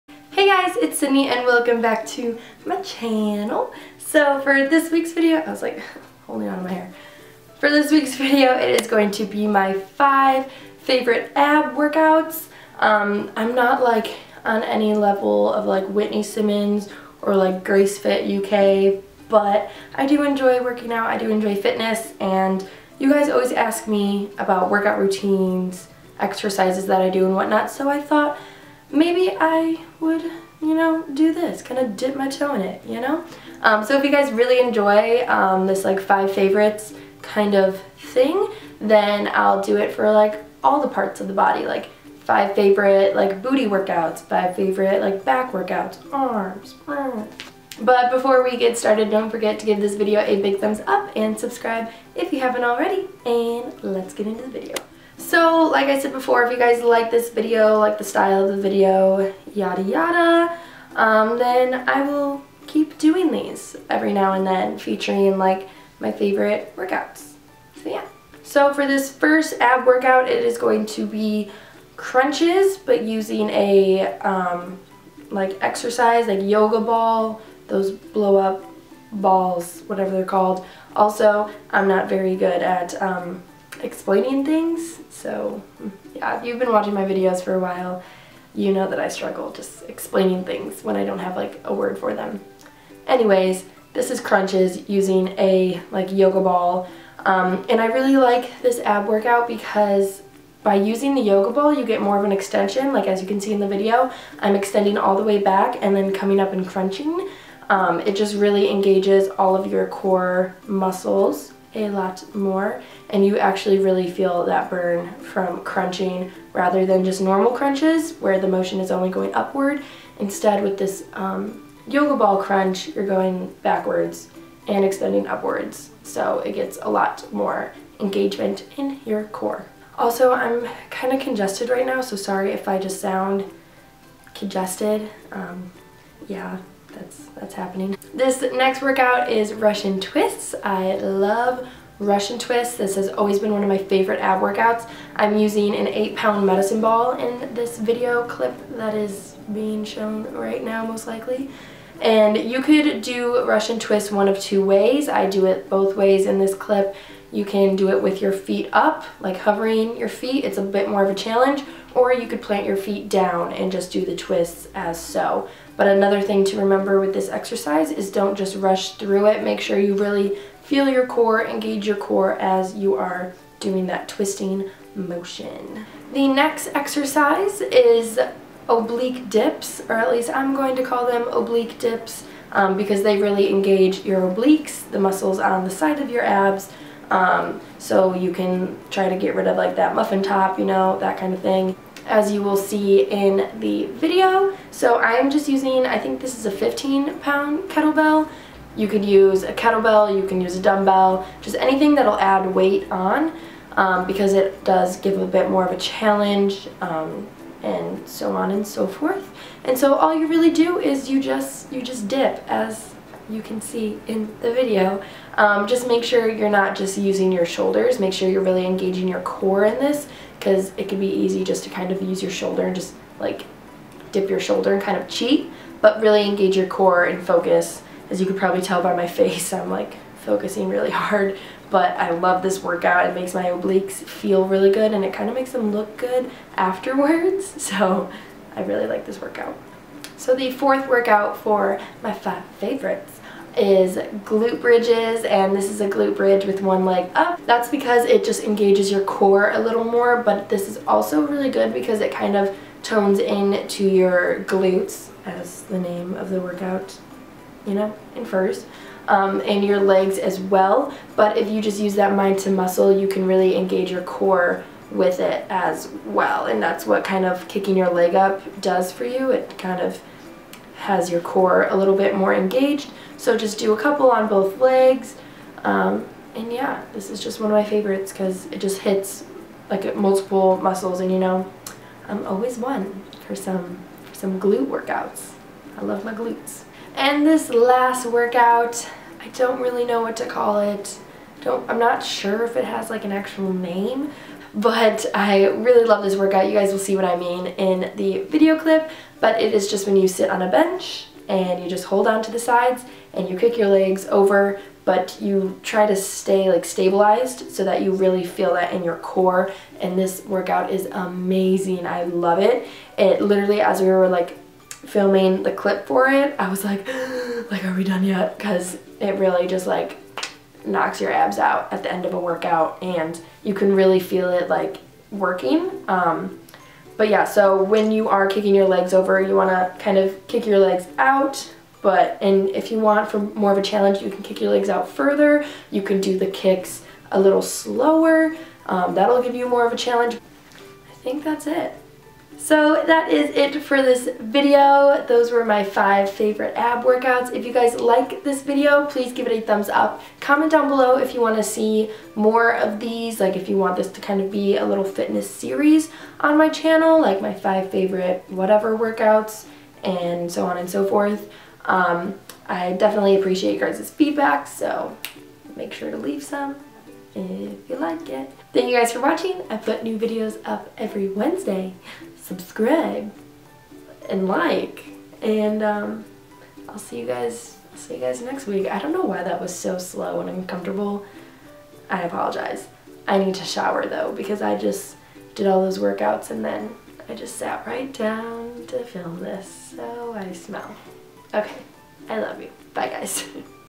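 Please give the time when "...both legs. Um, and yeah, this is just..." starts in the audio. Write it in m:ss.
4:34.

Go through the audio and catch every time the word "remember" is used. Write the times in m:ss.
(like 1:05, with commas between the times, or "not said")
2:46.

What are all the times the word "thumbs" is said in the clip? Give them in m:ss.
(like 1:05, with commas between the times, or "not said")
0:50, 5:49.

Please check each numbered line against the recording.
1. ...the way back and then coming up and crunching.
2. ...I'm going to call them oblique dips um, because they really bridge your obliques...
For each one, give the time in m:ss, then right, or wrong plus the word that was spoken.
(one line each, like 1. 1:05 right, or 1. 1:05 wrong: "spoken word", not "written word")
1. 1:45 right
2. 3:00 wrong: "engage", not "bridge".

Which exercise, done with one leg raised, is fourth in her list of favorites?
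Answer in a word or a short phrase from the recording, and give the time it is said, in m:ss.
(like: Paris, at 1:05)
glute bridges, at 4:04.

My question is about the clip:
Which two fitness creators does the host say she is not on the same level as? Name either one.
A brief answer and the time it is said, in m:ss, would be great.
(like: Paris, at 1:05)
Whitney Simmons, at 0:15.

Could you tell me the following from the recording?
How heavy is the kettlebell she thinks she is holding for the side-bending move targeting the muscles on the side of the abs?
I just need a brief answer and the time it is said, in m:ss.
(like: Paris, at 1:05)
15 pounds, at 3:16.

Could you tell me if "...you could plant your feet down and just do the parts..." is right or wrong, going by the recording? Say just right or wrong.
wrong.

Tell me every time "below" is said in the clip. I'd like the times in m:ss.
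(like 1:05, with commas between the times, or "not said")
5:50.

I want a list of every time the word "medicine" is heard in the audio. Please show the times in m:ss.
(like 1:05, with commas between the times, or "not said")
2:26.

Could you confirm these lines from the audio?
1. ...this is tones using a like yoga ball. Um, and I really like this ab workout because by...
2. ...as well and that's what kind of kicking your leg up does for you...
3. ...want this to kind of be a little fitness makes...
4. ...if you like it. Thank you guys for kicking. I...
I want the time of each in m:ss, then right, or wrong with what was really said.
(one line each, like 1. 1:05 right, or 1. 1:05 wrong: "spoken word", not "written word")
1. 1:33 wrong: "crunches", not "tones"
2. 4:25 right
3. 5:53 wrong: "series", not "makes"
4. 6:07 wrong: "watching", not "kicking".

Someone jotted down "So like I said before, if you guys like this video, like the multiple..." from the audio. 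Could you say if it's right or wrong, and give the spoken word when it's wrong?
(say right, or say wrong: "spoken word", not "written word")
wrong: "style", not "multiple".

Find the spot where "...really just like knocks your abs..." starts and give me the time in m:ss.
5:19.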